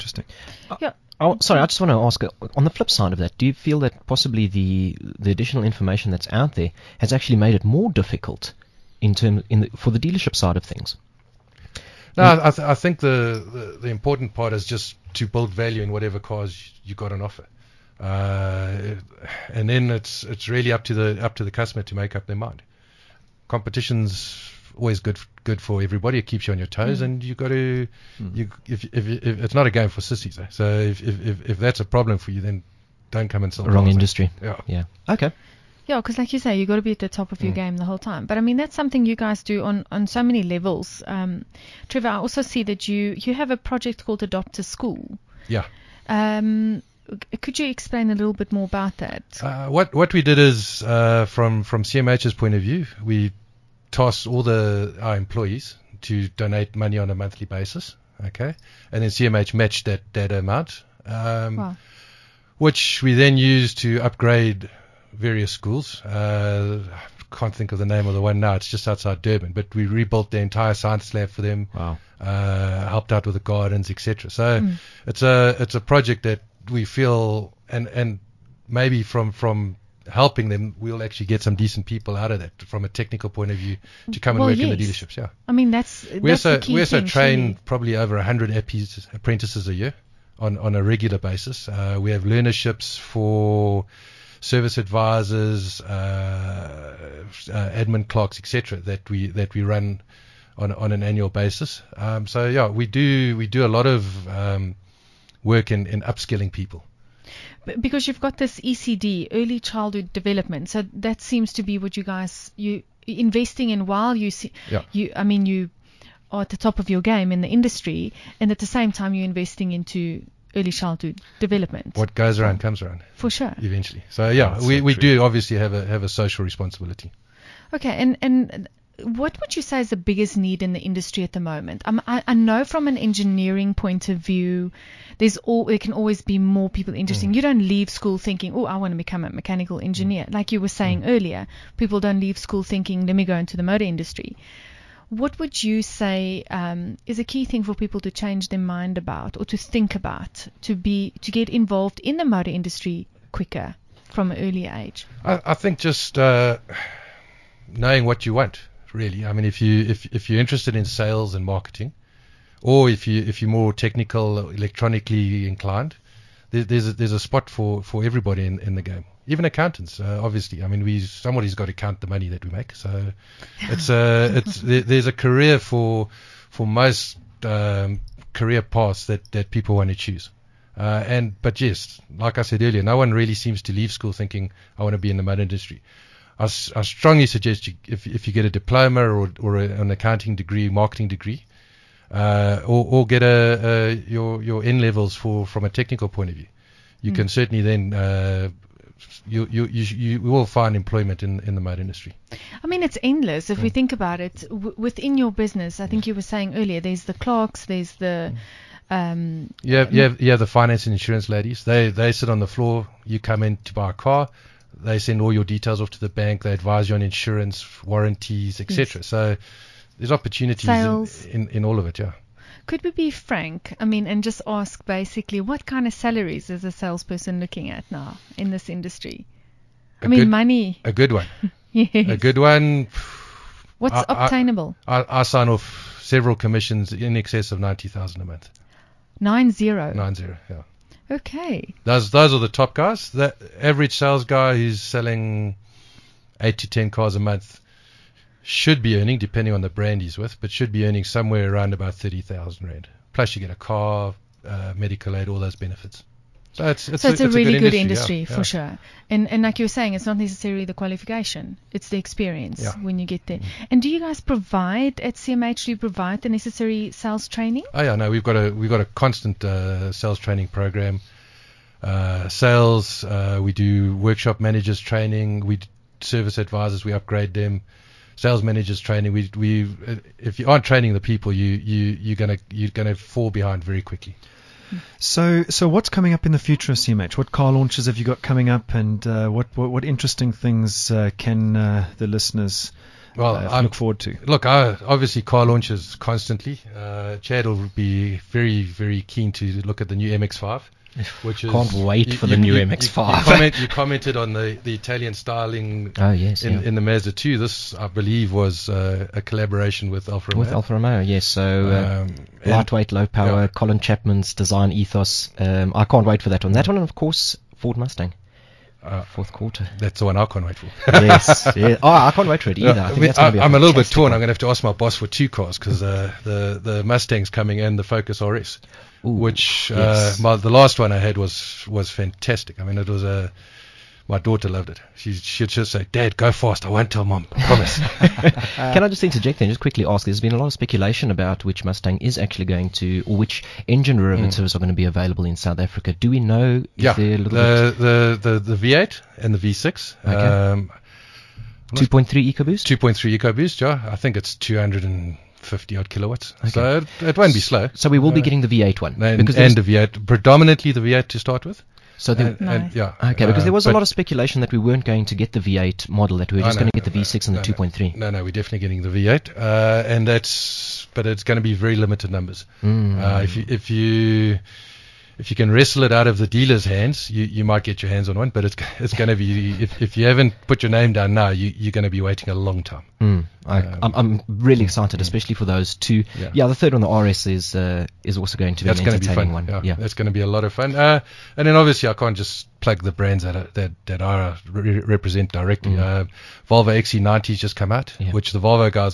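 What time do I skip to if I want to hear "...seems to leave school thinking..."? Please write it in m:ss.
3:03.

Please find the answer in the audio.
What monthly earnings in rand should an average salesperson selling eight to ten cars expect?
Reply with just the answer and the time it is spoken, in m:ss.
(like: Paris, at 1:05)
30,000 rand, at 4:11.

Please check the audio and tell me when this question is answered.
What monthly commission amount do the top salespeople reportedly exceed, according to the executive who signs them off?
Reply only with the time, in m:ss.
3:57.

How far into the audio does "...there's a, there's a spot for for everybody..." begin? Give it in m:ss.
2:46.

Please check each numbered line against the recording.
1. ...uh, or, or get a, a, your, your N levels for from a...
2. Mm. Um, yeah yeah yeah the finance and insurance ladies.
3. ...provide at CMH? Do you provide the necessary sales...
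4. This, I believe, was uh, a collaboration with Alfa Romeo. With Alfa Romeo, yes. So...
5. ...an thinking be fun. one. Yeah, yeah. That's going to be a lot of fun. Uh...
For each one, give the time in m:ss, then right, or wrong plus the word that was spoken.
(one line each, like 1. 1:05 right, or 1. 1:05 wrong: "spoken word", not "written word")
1. 3:12 right
2. 3:28 right
3. 4:24 right
4. 5:07 right
5. 6:28 wrong: "entertaining", not "thinking".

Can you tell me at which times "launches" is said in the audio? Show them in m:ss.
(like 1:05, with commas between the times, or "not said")
4:47, 4:55.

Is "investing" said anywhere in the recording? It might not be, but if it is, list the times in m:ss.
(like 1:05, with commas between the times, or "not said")
1:53, 1:59.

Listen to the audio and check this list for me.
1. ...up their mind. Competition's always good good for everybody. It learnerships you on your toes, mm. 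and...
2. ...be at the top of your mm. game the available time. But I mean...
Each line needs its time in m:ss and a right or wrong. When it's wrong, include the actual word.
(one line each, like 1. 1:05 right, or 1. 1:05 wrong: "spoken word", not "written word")
1. 0:22 wrong: "keeps", not "learnerships"
2. 0:36 wrong: "whole", not "available".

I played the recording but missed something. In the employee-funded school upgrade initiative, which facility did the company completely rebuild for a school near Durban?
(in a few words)
science lab.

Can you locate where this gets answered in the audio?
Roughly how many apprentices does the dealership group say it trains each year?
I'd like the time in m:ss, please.
1:27.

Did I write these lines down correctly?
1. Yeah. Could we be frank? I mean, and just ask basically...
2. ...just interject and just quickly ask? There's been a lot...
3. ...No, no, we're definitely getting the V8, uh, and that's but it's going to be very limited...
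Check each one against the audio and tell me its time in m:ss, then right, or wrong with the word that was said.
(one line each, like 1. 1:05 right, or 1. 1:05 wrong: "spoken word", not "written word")
1. 3:41 right
2. 5:38 right
3. 6:07 right.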